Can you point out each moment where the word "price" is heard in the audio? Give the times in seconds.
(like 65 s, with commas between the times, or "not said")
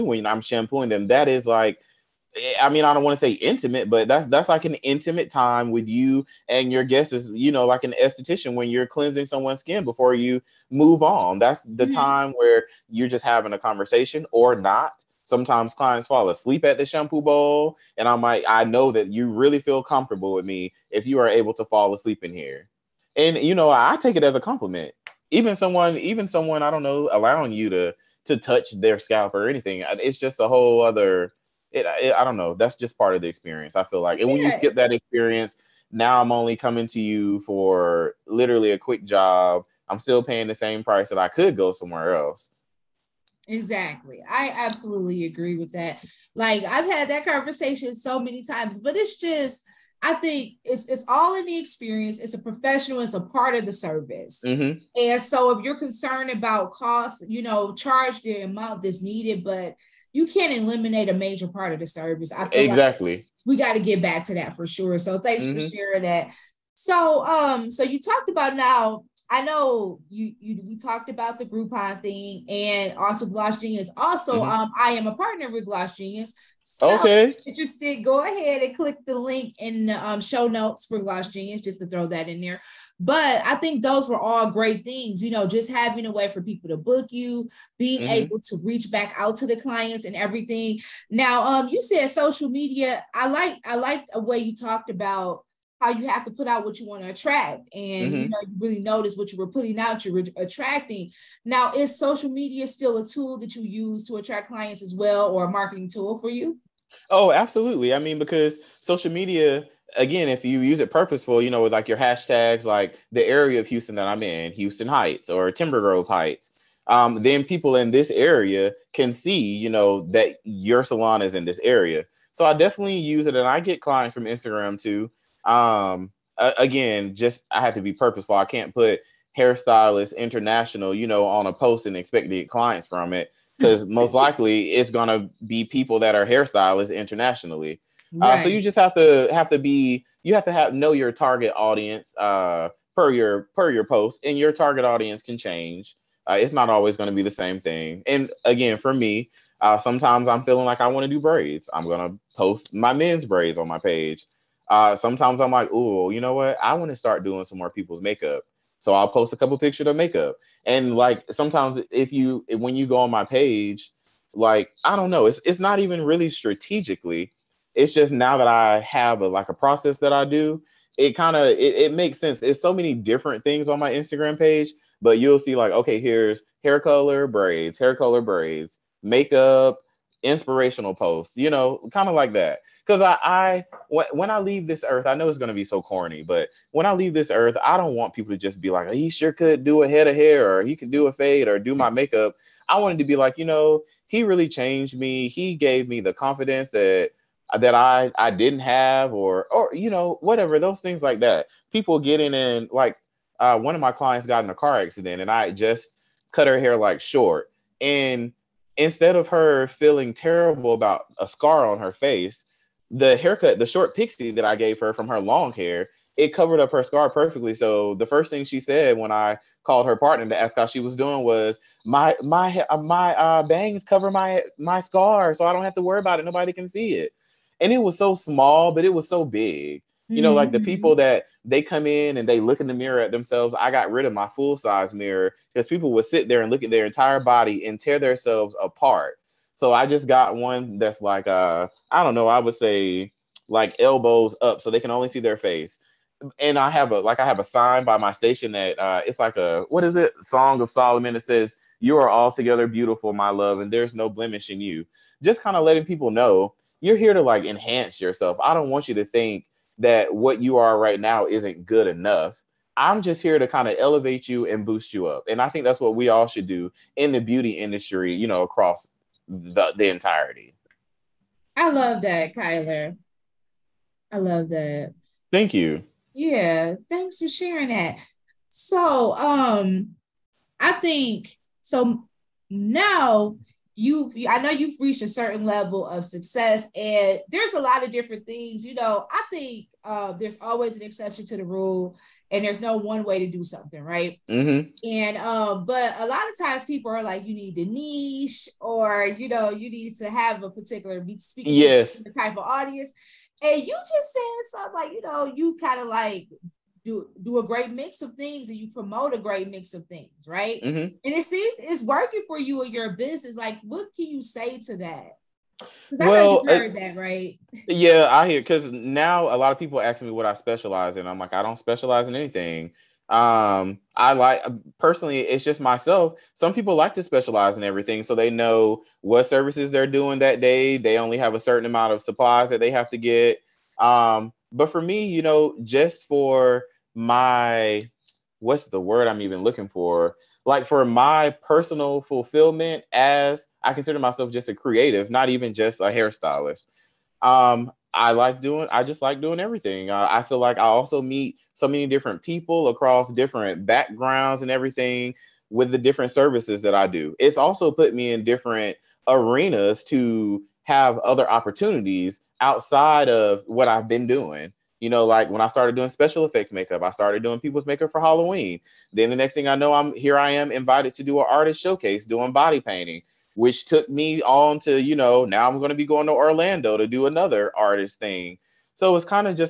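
40 s.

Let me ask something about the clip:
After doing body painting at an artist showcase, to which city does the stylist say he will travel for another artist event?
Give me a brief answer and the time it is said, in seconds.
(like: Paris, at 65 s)
Orlando, at 376 s.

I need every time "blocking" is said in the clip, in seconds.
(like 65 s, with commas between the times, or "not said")
not said.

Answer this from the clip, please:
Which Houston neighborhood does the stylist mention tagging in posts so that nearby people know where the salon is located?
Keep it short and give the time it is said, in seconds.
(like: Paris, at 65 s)
Houston Heights, at 114 s.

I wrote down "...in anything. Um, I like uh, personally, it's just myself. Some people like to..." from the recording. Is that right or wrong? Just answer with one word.
right.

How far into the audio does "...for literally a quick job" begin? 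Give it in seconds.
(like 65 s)
37 s.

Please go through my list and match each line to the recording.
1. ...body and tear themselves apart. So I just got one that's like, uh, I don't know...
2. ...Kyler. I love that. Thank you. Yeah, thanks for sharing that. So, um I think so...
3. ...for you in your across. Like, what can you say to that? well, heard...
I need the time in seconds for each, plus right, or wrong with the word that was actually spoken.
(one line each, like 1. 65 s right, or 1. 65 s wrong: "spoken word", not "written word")
1. 237 s right
2. 272 s right
3. 312 s wrong: "business", not "across".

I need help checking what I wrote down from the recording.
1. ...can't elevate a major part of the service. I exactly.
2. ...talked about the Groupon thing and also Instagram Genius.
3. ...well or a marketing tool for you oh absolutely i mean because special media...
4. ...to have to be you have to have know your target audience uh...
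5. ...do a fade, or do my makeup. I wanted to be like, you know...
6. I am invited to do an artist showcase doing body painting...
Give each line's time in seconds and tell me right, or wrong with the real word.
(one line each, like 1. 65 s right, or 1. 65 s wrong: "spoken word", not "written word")
1. 60 s wrong: "eliminate", not "elevate"
2. 70 s wrong: "Gloss", not "Instagram"
3. 104 s wrong: "social", not "special"
4. 138 s right
5. 190 s right
6. 370 s right.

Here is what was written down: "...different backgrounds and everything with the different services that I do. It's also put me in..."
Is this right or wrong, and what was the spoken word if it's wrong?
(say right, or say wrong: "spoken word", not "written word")
right.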